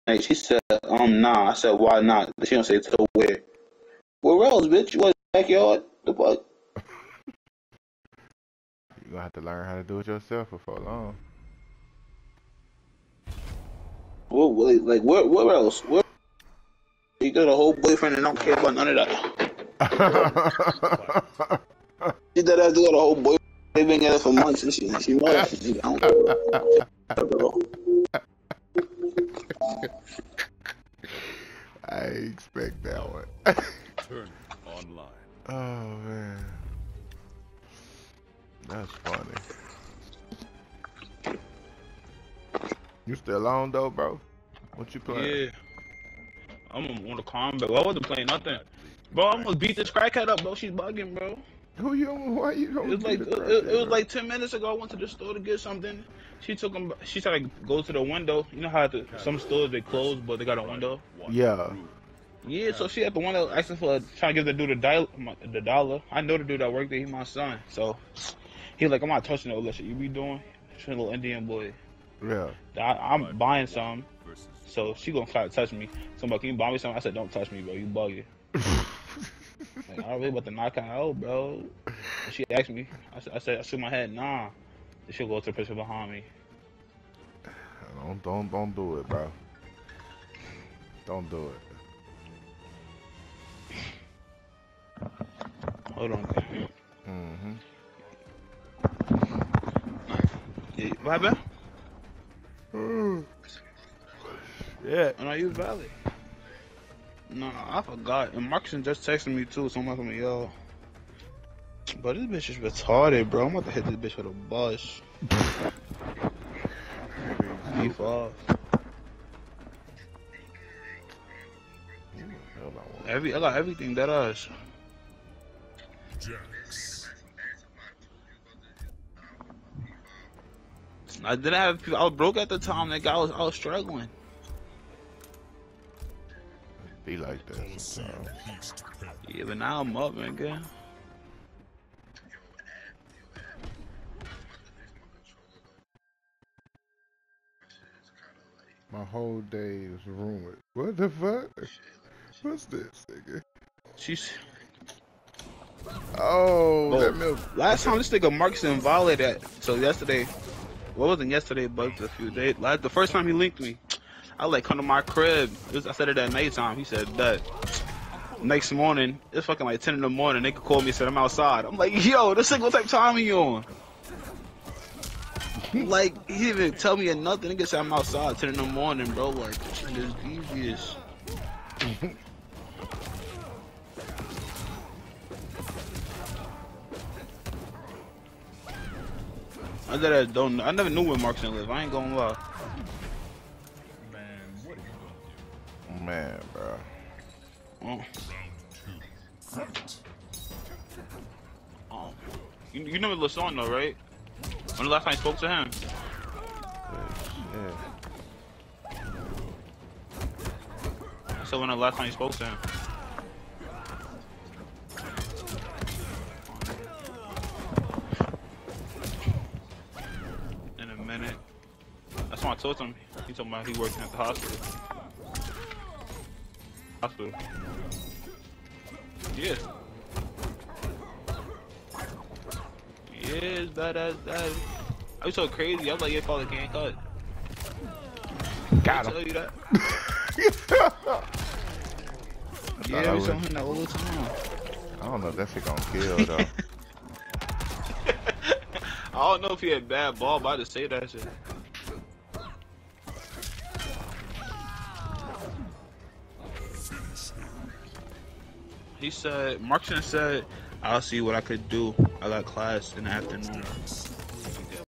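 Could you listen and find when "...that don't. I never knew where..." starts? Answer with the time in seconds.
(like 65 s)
189 s.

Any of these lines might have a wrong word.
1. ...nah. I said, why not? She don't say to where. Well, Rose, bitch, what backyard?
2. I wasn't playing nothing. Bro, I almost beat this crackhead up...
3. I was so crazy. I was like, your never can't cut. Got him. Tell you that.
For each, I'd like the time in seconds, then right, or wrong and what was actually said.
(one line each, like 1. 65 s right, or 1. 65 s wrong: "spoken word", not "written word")
1. 1 s right
2. 47 s right
3. 235 s wrong: "father", not "never".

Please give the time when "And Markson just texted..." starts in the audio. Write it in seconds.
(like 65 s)
108 s.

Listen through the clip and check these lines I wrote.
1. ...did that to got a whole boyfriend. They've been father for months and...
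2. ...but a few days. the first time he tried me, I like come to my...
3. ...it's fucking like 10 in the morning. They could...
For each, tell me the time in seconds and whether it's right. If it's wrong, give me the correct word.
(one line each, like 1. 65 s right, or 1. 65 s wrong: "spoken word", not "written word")
1. 22 s wrong: "together", not "father"
2. 161 s wrong: "linked", not "tried"
3. 169 s right.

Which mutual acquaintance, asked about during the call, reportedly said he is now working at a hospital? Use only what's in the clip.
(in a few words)
LaShawn.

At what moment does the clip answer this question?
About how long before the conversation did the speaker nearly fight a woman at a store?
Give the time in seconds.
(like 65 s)
54 s.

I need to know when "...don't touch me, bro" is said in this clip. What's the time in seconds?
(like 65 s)
77 s.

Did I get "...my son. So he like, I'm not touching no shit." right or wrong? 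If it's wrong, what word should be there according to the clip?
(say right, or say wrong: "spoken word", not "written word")
right.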